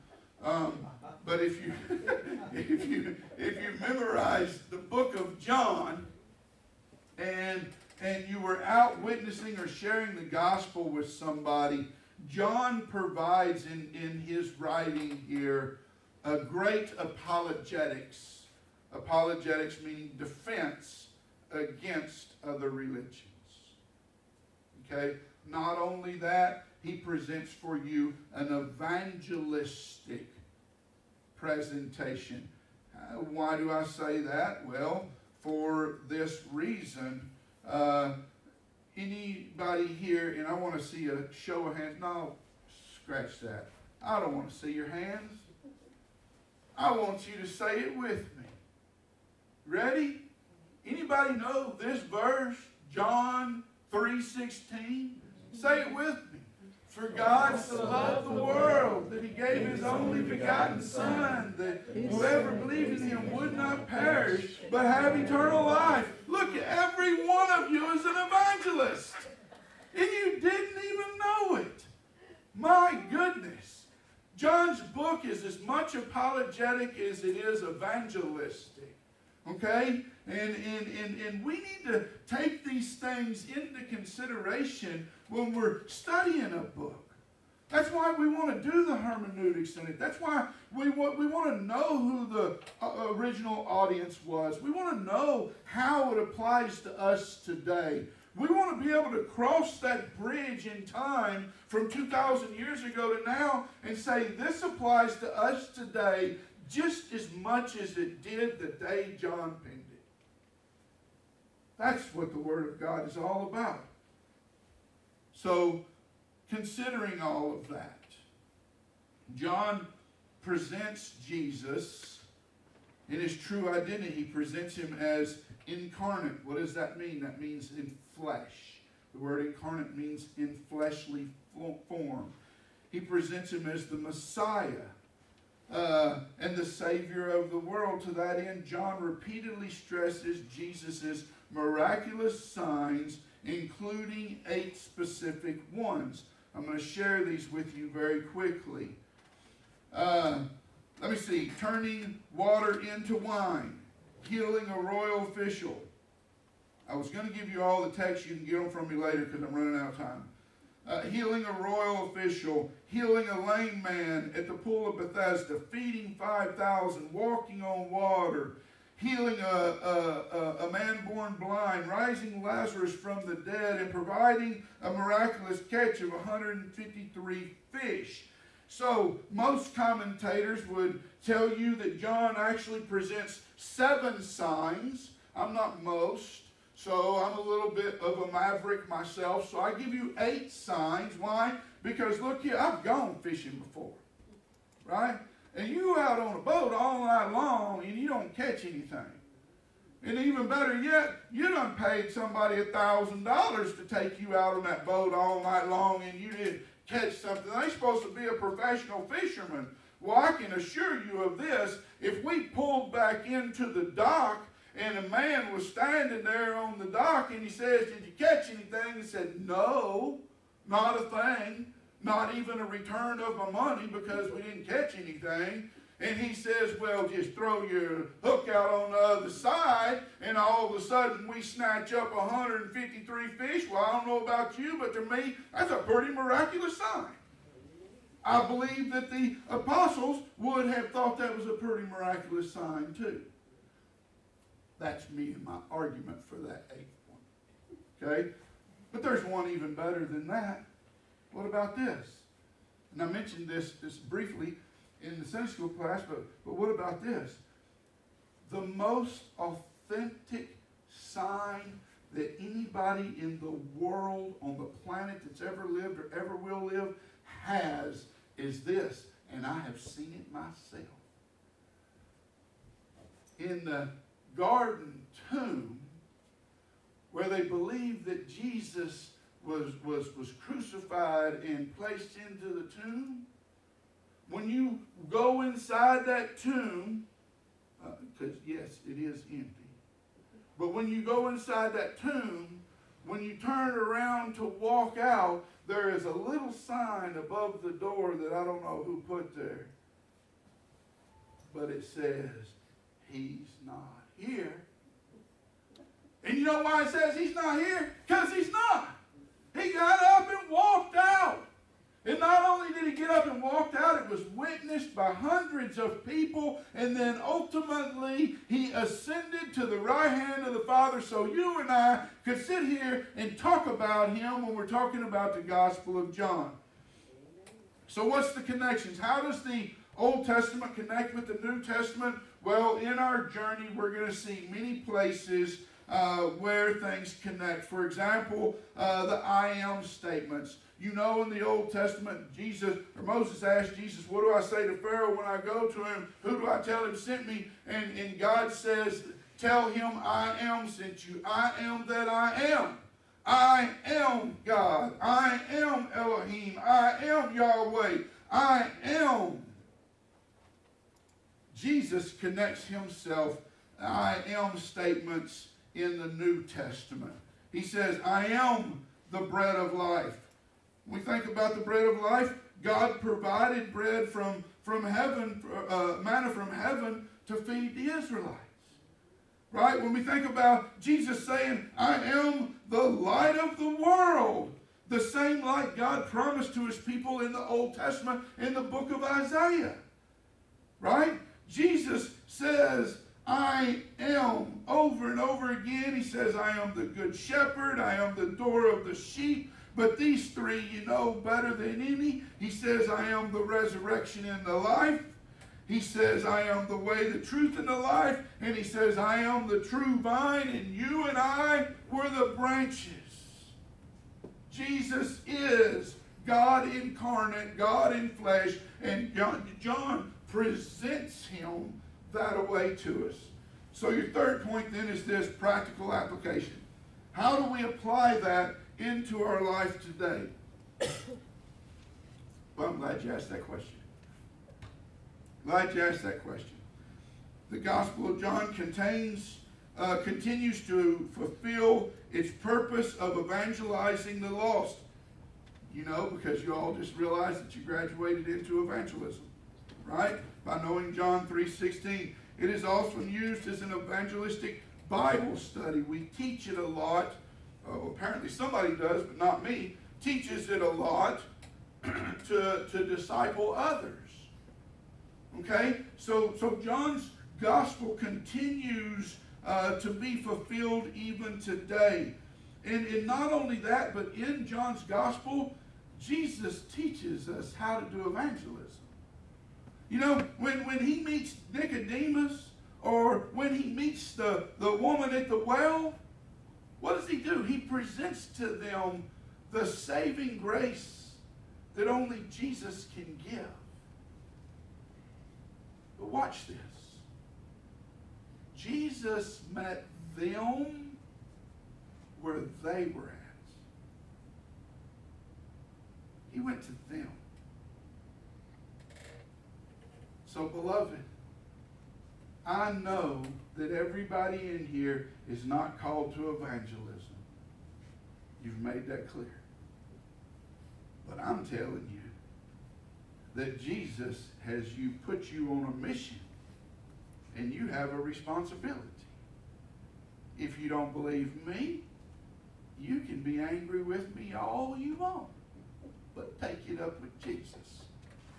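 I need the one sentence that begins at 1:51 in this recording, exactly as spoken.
That's what the Word of God is all about.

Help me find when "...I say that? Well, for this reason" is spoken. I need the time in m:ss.
0:33.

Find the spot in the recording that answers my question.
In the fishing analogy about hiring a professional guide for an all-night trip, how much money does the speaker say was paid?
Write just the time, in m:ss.
3:22.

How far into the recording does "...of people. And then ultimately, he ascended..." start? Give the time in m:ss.
5:15.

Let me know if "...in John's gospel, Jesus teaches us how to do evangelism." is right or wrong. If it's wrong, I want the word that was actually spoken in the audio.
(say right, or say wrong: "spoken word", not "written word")
right.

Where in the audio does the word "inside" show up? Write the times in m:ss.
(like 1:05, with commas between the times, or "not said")
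4:45, 4:51.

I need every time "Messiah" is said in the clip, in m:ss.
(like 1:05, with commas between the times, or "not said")
2:13.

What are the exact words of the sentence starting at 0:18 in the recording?
Apologetics meaning defense against other religions.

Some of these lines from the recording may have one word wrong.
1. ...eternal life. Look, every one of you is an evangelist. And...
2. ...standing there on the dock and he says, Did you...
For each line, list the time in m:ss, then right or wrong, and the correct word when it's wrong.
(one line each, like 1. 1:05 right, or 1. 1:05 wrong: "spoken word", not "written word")
1. 1:05 right
2. 3:35 right.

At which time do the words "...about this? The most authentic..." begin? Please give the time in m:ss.
4:16.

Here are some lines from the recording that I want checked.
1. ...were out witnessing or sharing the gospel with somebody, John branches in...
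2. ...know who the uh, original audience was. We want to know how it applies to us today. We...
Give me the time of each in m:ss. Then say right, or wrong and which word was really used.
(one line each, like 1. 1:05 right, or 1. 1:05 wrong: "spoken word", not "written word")
1. 0:08 wrong: "provides", not "branches"
2. 1:31 right.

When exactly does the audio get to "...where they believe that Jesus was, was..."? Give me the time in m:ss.
4:37.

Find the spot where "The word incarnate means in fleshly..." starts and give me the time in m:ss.
2:09.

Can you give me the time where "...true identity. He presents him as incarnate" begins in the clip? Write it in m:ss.
2:03.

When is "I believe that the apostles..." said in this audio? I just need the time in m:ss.
3:58.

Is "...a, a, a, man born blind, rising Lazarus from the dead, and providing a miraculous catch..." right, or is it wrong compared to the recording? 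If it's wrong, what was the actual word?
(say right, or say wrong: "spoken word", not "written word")
right.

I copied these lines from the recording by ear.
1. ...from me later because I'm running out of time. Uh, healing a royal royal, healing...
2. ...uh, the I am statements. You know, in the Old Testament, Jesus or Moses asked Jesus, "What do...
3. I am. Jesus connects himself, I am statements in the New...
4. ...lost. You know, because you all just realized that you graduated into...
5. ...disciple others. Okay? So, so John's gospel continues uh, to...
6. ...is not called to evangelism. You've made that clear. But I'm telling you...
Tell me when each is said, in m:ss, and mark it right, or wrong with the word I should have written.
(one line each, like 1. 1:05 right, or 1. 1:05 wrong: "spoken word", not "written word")
1. 2:38 wrong: "official", not "royal"
2. 5:38 right
3. 5:58 right
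4. 7:24 right
5. 7:42 right
6. 8:35 right.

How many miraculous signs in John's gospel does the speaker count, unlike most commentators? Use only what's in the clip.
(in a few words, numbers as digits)
8.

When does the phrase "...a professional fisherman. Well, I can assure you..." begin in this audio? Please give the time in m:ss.
3:28.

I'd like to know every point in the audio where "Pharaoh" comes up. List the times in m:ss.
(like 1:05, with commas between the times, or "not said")
5:44.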